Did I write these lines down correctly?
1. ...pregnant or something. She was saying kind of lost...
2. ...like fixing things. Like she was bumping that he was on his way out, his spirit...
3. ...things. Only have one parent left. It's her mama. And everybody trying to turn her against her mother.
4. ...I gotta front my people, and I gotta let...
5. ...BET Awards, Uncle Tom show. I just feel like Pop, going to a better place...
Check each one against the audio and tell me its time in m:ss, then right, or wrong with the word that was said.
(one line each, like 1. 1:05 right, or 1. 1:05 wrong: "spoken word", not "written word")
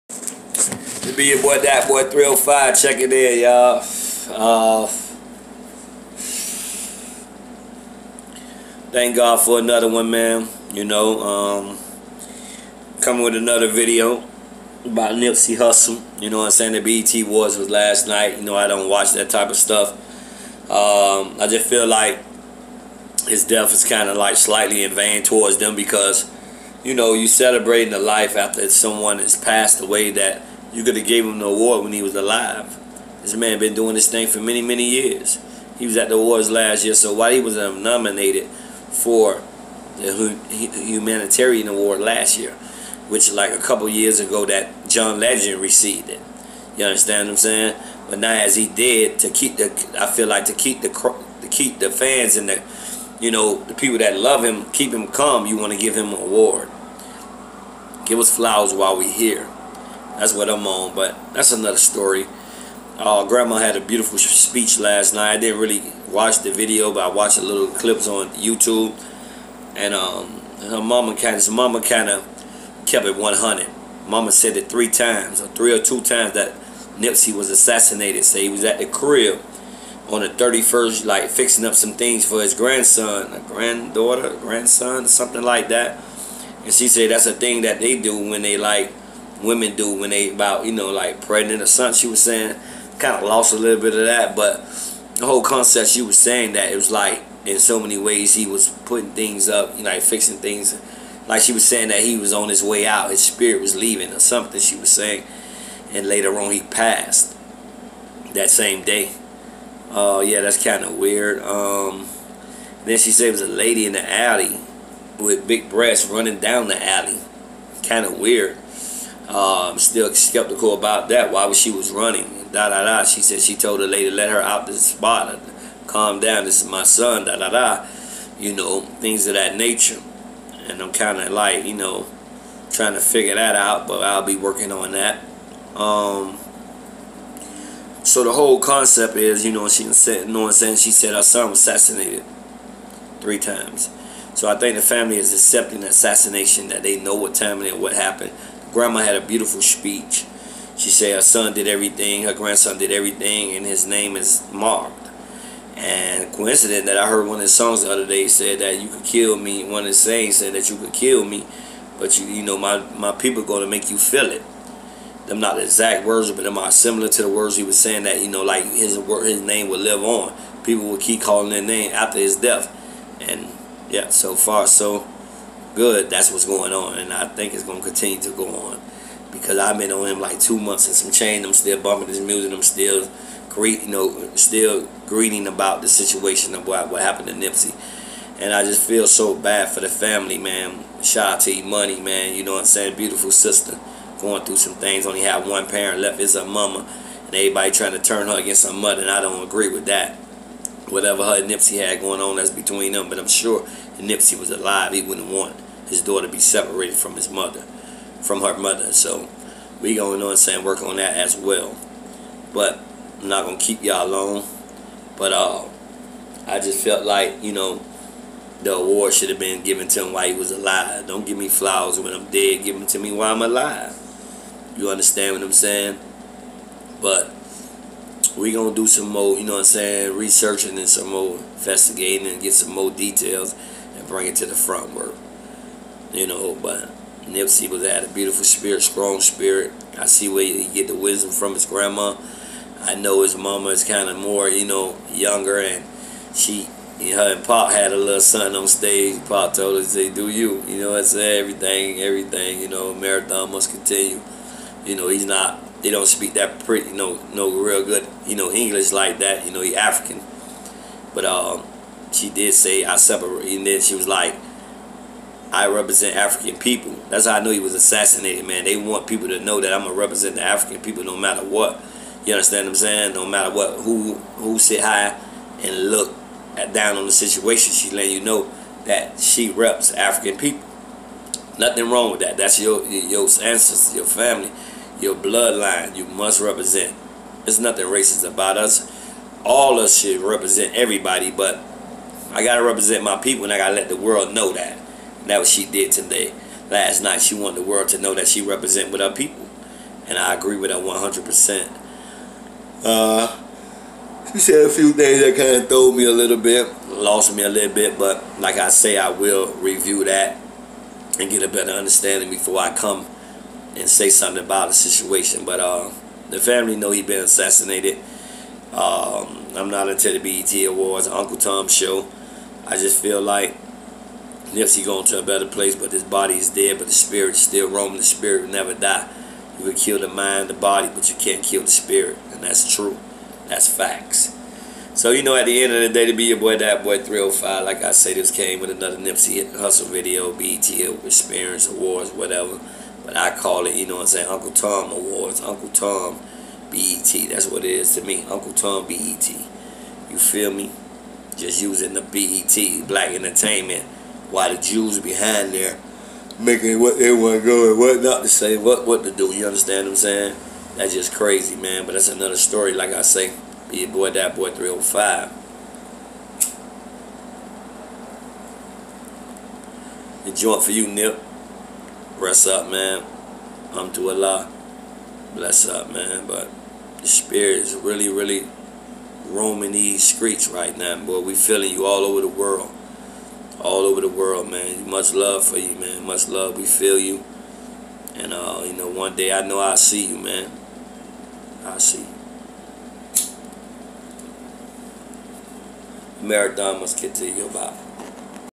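1. 1:31 right
2. 1:39 wrong: "saying", not "bumping"
3. 3:14 right
4. 4:52 wrong: "represent", not "front"
5. 5:20 wrong: "Yes", not "Pop".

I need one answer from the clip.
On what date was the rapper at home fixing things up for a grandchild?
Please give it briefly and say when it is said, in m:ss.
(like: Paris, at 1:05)
31st, at 1:20.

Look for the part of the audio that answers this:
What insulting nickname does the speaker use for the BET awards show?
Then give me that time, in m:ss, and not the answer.
5:44.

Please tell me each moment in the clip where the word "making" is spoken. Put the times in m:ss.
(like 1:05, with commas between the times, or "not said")
5:56.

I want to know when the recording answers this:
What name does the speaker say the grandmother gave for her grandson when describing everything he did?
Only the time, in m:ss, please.
2:34.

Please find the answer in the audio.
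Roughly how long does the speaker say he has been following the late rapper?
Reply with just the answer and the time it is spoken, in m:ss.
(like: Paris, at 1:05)
Two months, at 3:00.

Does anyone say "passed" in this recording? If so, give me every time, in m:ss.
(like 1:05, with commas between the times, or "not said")
0:29, 1:46.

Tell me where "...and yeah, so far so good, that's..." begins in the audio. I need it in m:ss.
2:53.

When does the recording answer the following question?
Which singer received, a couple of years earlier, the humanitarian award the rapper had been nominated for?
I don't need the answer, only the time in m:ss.
0:44.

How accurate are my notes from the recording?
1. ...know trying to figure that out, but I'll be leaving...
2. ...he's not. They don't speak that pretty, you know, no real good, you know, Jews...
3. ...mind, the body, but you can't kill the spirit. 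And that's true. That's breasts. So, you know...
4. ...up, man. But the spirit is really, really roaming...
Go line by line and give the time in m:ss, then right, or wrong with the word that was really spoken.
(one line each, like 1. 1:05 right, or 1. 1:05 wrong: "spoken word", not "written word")
1. 2:11 wrong: "working", not "leaving"
2. 4:15 wrong: "English", not "Jews"
3. 5:30 wrong: "facts", not "breasts"
4. 6:15 right.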